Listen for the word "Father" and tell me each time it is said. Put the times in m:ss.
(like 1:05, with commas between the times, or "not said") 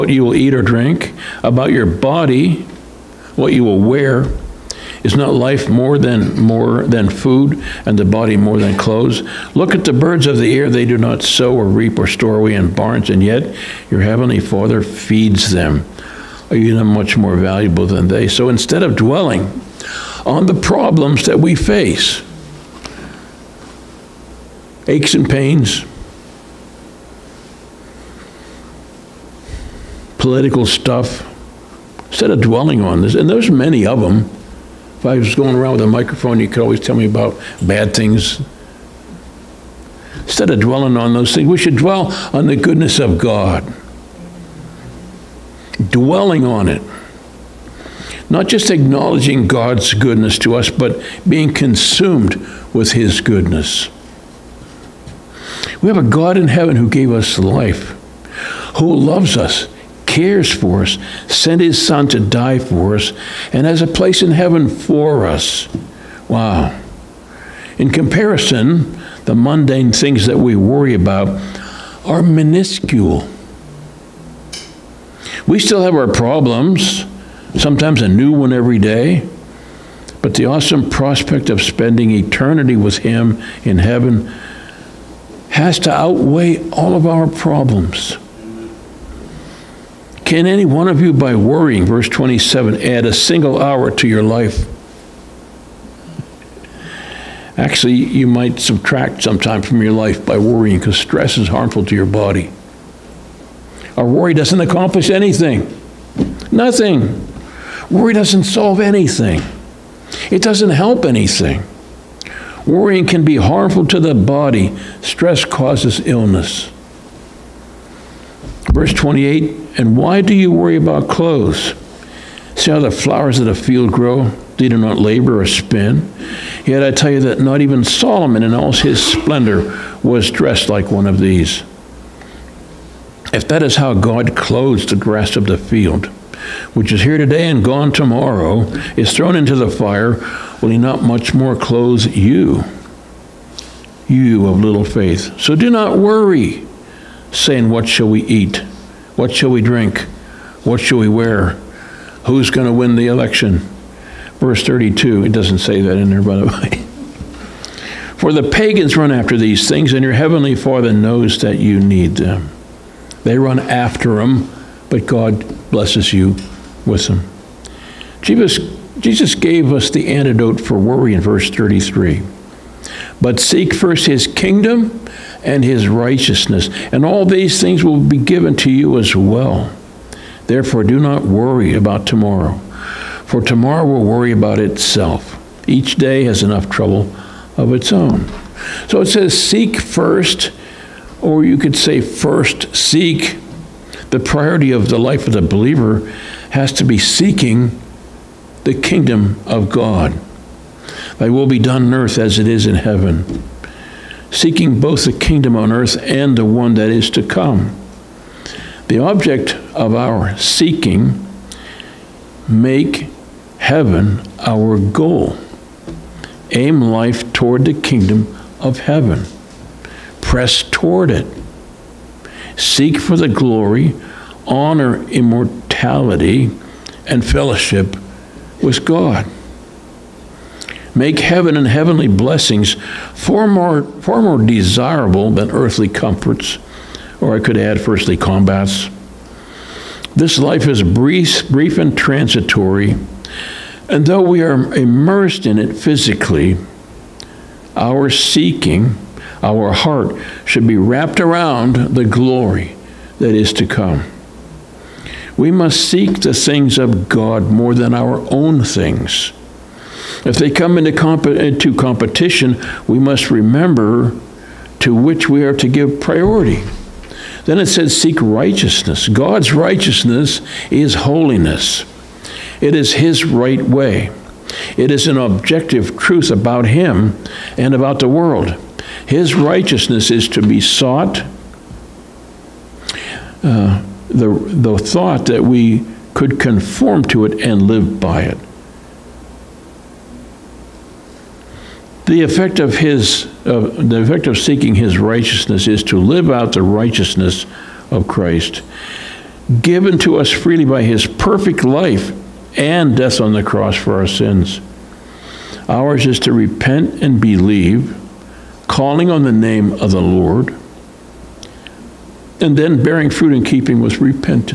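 0:14, 2:40.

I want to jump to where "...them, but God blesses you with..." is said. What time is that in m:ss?
2:44.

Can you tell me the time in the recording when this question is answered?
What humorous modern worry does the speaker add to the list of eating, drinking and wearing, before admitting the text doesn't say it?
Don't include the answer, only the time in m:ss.
2:32.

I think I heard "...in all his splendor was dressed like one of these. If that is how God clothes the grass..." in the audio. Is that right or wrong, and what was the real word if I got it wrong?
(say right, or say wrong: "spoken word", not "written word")
right.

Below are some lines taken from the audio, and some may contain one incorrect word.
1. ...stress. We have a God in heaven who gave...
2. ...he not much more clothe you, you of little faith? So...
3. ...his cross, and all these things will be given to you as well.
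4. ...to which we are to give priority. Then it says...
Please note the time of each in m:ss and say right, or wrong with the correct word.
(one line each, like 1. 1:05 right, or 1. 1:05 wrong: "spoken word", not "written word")
1. 0:53 wrong: "goodness", not "stress"
2. 2:20 right
3. 2:55 wrong: "righteousness", not "cross"
4. 4:24 right.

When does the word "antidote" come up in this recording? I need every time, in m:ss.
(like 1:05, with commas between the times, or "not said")
2:50.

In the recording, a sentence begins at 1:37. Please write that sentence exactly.
Actually, you might subtract time from your life by worrying because stress is harmful to your body.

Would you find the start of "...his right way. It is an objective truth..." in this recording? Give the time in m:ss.
4:32.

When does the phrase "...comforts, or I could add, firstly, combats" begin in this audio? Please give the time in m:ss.
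3:55.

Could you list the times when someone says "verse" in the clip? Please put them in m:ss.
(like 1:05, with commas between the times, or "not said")
1:31, 1:58, 2:34, 2:51.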